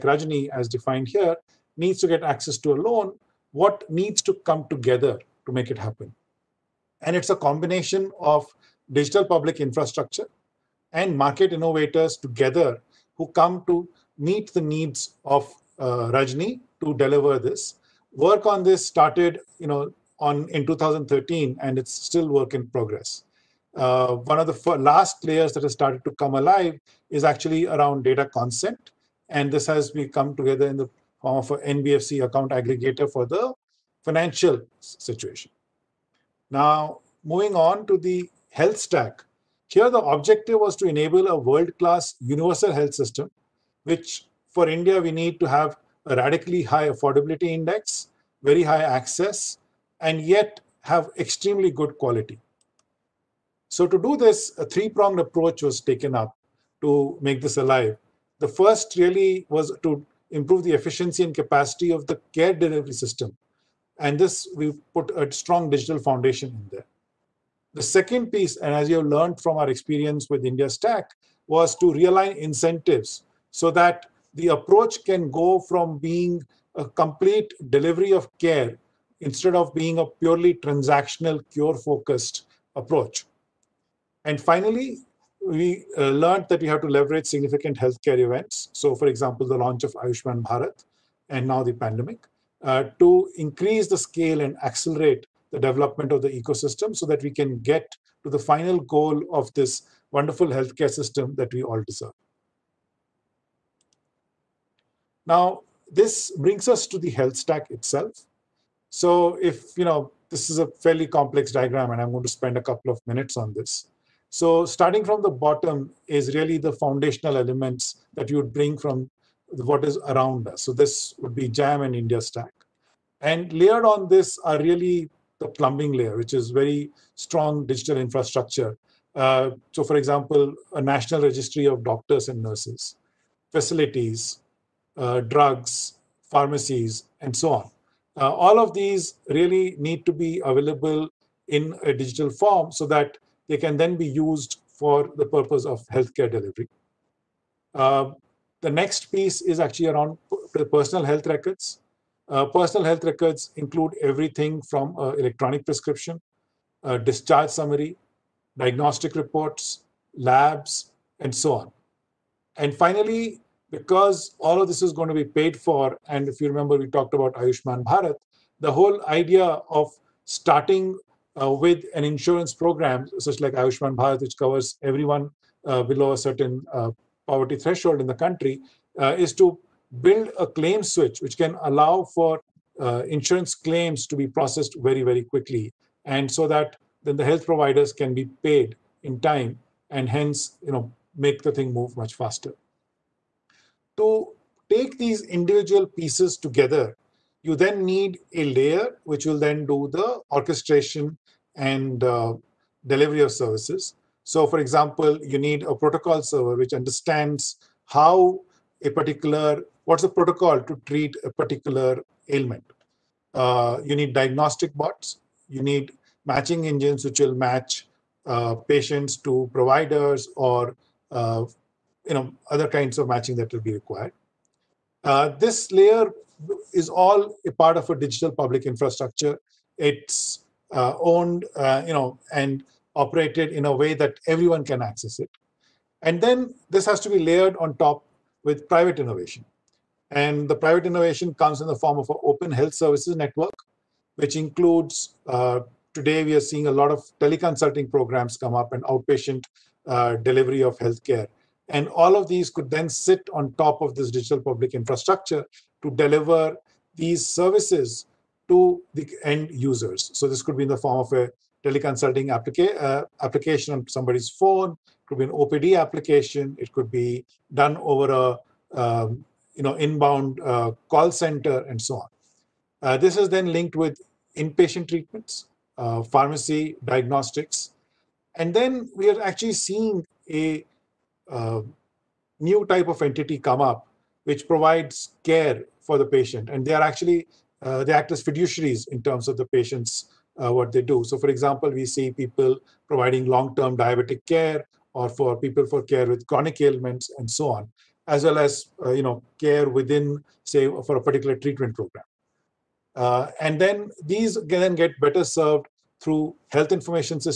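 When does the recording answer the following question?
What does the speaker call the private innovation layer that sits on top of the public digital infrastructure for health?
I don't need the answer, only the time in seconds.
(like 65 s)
242 s.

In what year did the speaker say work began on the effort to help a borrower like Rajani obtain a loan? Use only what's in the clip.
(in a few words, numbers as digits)
2013.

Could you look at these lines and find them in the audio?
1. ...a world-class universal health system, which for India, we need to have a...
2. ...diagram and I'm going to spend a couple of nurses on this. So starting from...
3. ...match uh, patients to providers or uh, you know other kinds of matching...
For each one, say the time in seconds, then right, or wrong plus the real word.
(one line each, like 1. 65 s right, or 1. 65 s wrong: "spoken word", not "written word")
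1. 41 s right
2. 111 s wrong: "minutes", not "nurses"
3. 217 s right.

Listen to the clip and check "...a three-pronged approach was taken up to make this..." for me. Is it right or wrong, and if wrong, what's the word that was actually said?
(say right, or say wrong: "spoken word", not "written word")
right.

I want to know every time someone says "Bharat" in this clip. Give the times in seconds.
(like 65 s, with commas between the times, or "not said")
90 s, 167 s, 173 s.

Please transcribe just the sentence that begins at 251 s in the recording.
And all of these could then sit on top of this digital public infrastructure to deliver these services to the end users.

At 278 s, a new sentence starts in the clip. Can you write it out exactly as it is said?
And then we are actually seeing a uh, new type of entity come up, which provides care for the patient.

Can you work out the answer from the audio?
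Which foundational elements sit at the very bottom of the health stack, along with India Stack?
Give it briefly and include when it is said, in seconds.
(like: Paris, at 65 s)
JAM, at 121 s.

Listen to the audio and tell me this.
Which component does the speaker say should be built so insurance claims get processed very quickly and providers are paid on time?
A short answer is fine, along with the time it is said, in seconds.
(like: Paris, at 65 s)
claim switch, at 180 s.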